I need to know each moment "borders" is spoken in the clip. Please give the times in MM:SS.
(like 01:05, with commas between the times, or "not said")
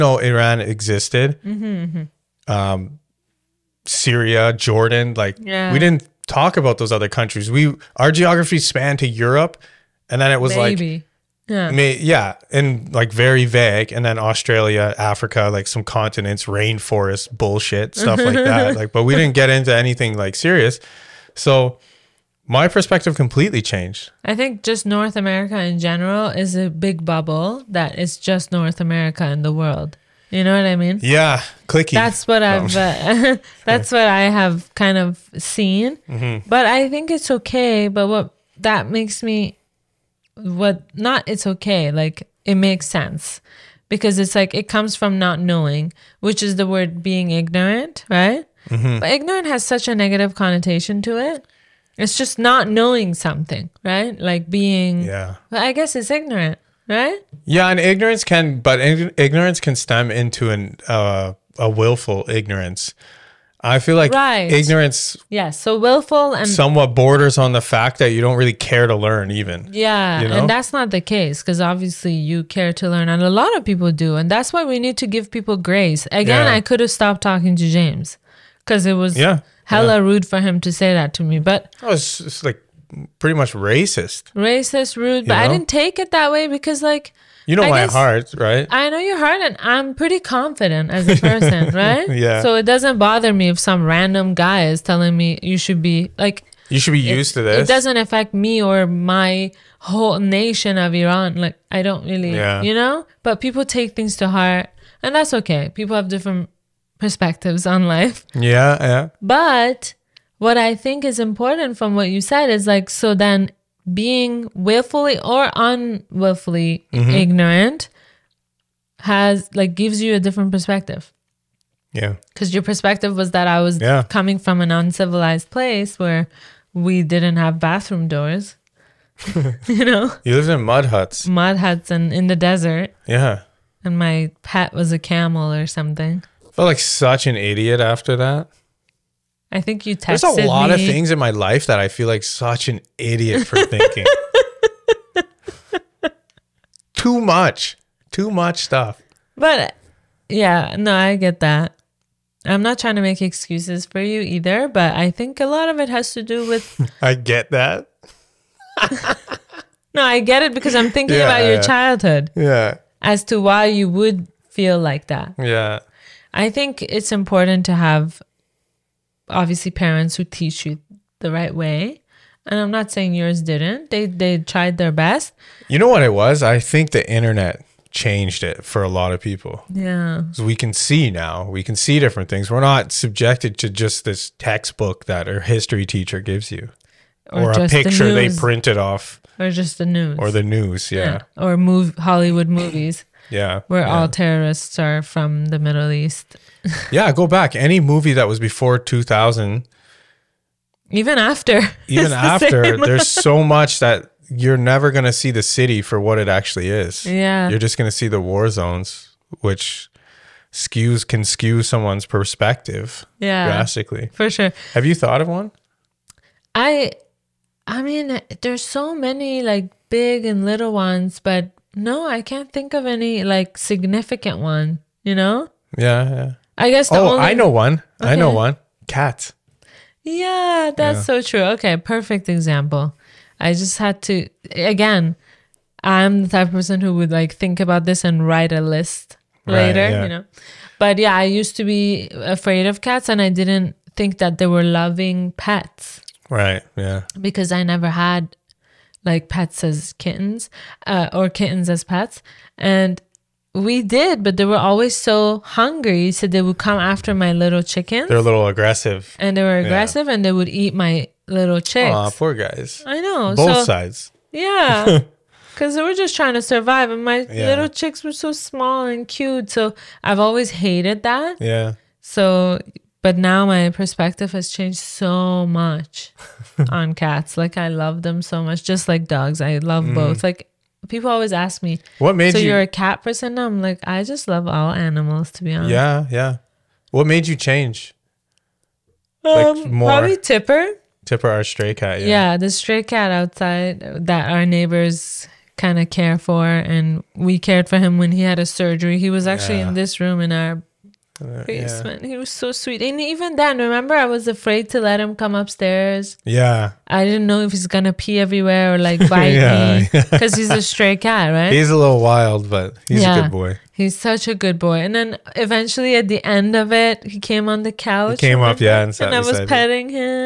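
01:06.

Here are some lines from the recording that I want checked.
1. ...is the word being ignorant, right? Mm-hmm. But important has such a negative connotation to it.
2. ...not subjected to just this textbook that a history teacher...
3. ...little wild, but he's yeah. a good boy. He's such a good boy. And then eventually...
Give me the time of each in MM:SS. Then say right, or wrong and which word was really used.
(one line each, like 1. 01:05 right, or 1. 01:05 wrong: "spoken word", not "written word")
1. 00:46 wrong: "ignorant", not "important"
2. 03:02 right
3. 05:11 right.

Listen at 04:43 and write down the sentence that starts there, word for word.
I'm like, I just love all animals, to be honest.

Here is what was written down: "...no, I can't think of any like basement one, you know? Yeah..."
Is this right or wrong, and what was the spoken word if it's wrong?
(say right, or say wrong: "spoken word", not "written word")
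wrong: "significant", not "basement".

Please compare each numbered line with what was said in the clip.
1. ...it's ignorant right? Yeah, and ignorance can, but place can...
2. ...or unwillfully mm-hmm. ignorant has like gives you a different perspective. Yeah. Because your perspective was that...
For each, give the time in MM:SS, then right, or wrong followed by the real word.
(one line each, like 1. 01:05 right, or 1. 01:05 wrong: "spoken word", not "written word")
1. 00:55 wrong: "ignorance", not "place"
2. 01:55 right.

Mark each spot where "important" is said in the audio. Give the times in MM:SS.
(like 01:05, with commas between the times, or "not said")
01:51, 02:47.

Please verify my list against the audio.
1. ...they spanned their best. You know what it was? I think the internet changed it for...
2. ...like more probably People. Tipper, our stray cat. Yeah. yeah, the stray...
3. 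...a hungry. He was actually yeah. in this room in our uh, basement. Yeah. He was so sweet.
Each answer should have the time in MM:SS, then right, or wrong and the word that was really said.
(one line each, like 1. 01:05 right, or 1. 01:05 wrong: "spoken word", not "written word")
1. 02:54 wrong: "tried", not "spanned"
2. 04:49 wrong: "Tipper", not "People"
3. 04:58 wrong: "surgery", not "hungry".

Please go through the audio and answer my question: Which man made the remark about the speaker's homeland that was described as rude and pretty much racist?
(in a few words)
James.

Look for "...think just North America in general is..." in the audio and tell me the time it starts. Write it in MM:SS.
00:24.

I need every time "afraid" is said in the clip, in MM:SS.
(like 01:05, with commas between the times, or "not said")
04:02, 05:04.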